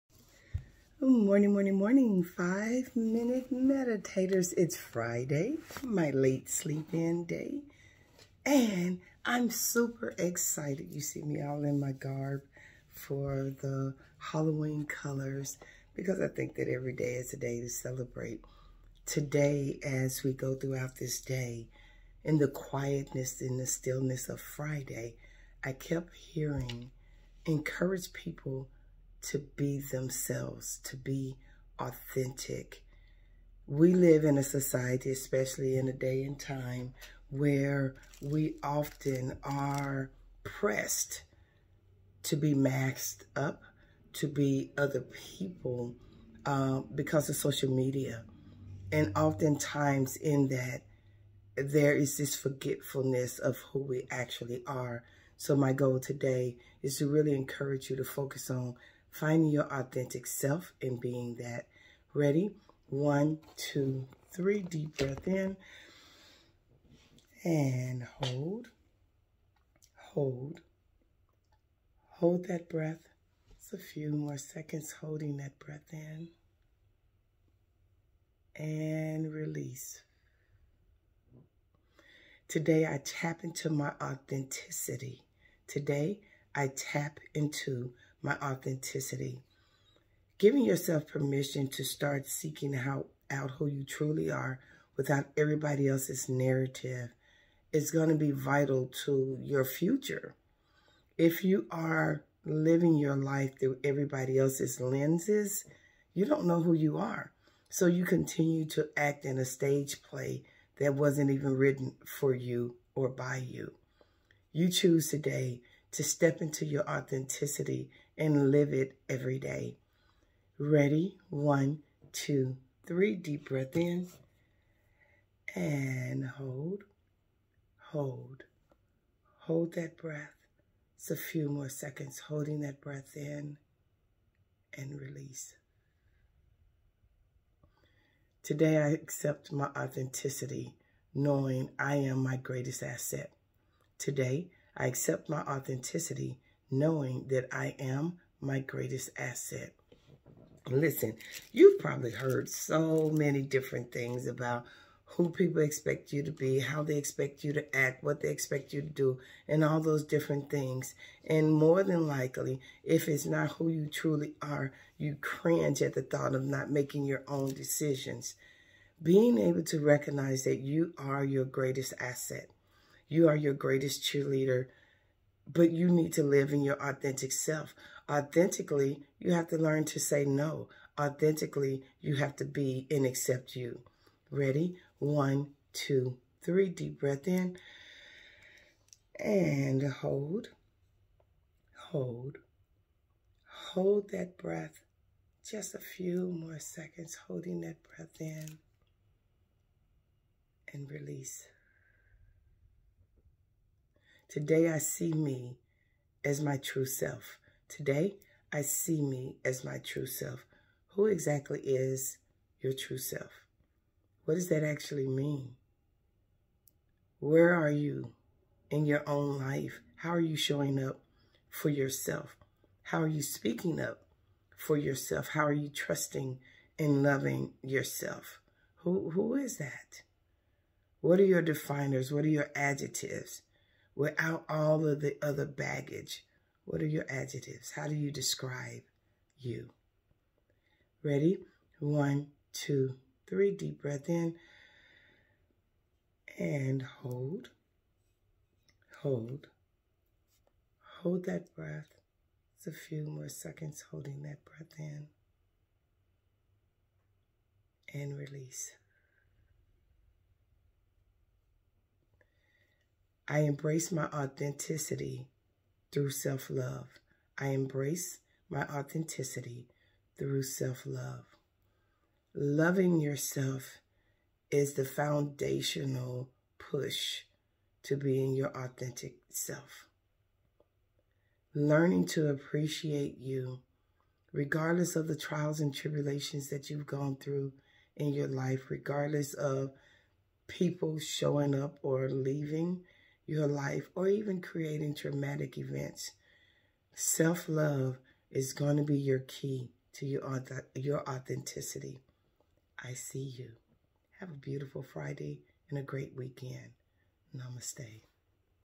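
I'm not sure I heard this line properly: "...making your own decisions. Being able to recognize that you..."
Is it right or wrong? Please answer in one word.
right.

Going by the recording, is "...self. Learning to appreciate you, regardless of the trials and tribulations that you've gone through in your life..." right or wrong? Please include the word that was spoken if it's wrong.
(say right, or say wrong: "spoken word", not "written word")
right.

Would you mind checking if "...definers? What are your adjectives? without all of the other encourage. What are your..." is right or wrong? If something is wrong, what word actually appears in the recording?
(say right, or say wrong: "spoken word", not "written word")
wrong: "baggage", not "encourage".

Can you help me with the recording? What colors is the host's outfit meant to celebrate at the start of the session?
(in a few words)
Halloween colors.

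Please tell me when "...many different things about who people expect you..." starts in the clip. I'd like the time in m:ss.
2:33.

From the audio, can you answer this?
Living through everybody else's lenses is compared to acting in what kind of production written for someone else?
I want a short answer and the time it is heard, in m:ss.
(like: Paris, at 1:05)
stage play, at 1:49.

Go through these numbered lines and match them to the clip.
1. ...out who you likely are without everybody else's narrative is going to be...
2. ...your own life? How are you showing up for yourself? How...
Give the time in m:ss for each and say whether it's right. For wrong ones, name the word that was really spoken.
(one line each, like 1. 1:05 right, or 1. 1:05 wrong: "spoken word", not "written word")
1. 1:33 wrong: "truly", not "likely"
2. 3:38 right.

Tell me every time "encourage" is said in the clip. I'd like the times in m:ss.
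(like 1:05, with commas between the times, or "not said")
0:27, 0:57.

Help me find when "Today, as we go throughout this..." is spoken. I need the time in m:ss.
0:19.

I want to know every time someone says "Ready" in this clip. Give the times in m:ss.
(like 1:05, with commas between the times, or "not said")
1:02, 2:00, 3:04, 4:01.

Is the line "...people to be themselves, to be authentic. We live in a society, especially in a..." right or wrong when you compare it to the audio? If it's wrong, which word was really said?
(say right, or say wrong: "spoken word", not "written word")
right.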